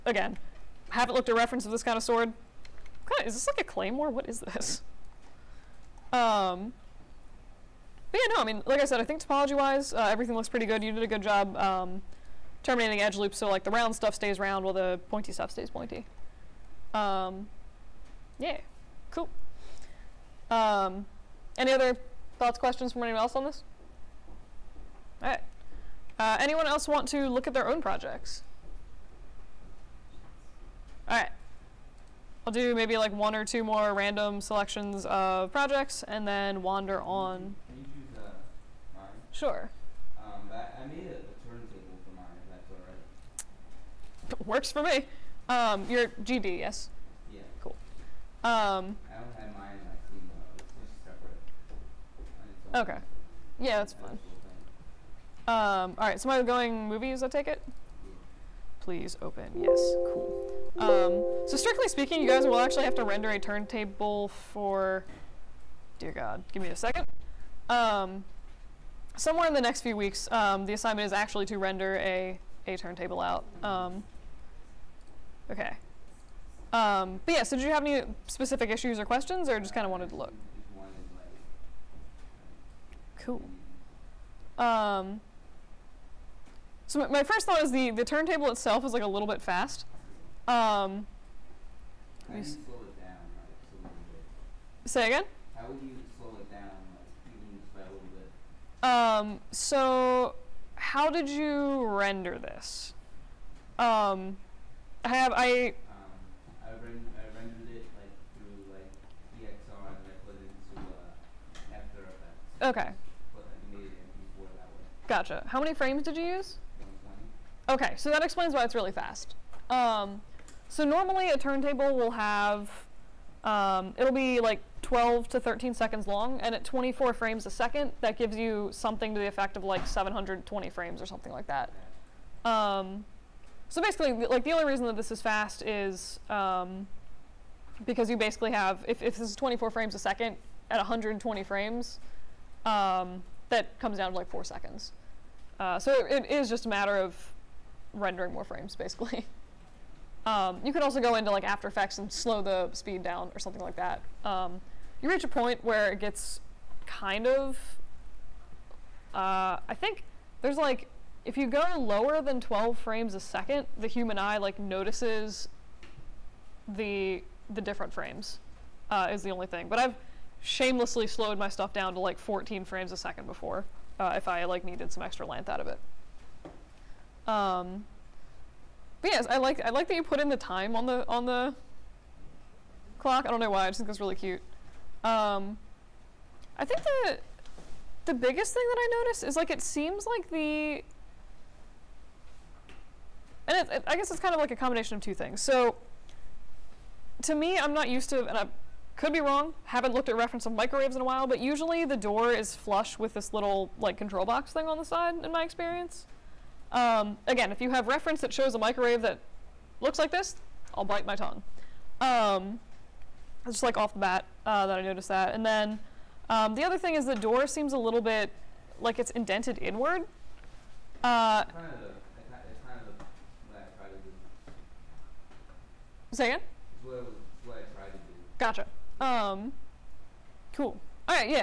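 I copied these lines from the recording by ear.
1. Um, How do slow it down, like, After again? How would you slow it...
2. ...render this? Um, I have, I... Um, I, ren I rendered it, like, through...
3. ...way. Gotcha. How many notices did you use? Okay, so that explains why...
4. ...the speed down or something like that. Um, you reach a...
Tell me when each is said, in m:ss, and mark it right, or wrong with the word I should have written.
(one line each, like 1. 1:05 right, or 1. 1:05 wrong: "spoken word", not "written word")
1. 1:30 wrong: "Say", not "After"
2. 1:41 right
3. 1:54 wrong: "frames", not "notices"
4. 2:32 right.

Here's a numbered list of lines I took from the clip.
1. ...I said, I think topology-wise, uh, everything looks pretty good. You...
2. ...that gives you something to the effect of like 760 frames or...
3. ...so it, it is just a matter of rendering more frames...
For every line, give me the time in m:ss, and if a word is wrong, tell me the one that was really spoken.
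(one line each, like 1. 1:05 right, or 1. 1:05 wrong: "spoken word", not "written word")
1. 0:08 right
2. 2:08 wrong: "720", not "760"
3. 2:25 right.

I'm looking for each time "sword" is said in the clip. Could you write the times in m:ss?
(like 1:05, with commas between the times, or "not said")
0:02.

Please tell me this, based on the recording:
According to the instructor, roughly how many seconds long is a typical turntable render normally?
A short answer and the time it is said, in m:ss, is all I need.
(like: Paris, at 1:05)
12 to 13 seconds, at 2:04.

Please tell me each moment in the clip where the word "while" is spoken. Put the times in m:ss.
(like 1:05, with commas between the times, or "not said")
0:14, 3:21.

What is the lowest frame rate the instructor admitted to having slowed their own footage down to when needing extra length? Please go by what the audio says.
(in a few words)
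14 frames a second.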